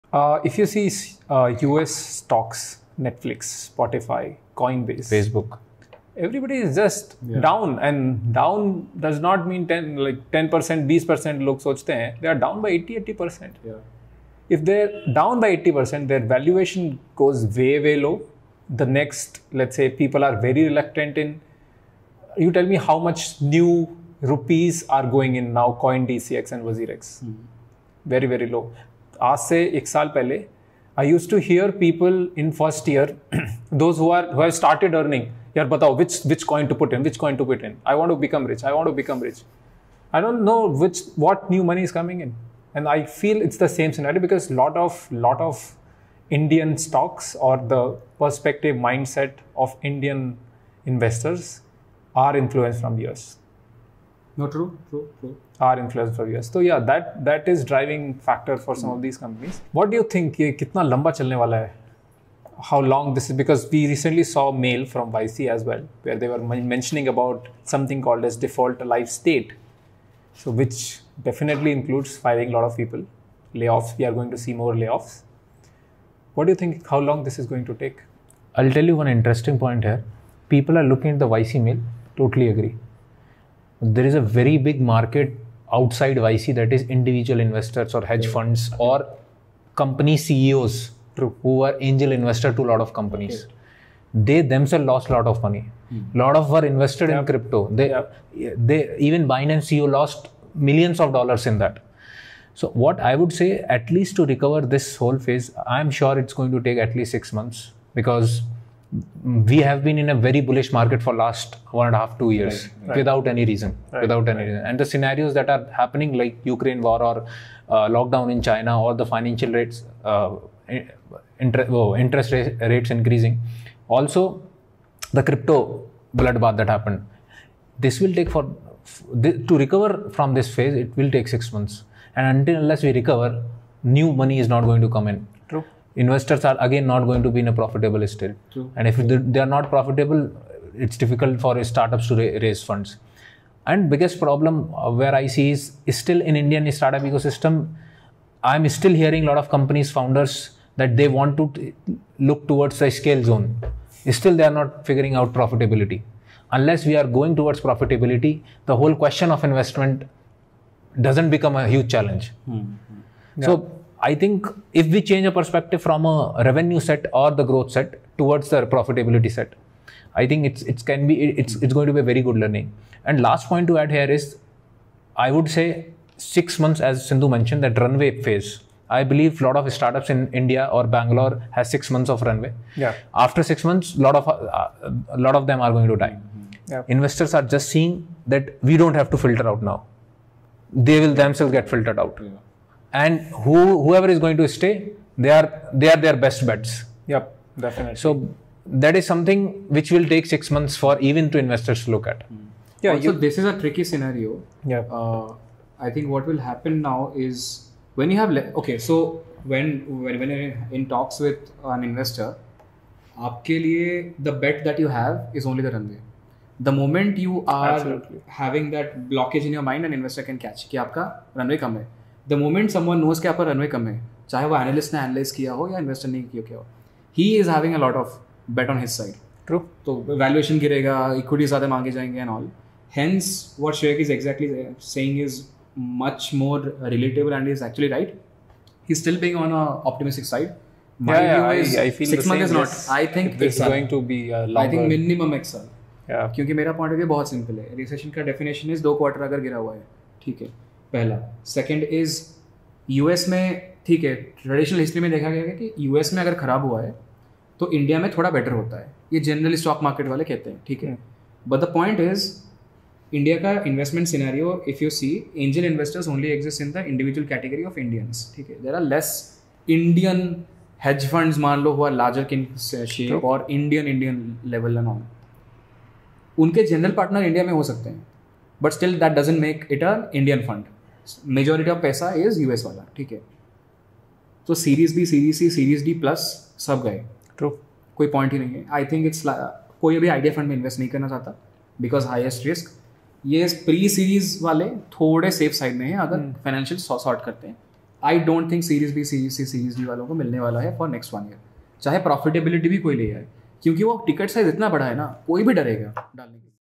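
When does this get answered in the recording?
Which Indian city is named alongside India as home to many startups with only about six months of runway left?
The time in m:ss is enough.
3:00.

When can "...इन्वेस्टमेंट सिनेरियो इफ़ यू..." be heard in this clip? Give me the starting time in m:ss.
4:23.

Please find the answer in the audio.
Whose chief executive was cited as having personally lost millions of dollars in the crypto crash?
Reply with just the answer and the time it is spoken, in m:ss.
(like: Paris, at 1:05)
Binance, at 1:39.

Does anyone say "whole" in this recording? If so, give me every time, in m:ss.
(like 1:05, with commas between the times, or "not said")
1:44, 2:38.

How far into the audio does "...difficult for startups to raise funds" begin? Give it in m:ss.
2:20.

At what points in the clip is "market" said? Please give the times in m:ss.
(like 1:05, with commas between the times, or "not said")
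1:24, 1:50.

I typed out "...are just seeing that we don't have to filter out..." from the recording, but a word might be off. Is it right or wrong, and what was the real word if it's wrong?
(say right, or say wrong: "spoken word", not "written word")
right.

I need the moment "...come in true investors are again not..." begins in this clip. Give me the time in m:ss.
2:14.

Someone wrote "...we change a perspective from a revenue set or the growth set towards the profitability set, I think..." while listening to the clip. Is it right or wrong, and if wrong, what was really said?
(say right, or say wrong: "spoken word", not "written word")
right.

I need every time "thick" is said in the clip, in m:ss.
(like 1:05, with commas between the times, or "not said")
not said.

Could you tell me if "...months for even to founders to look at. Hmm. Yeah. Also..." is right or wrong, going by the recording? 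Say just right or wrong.
wrong.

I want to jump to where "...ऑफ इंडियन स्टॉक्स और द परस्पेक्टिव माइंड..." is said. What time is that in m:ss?
0:45.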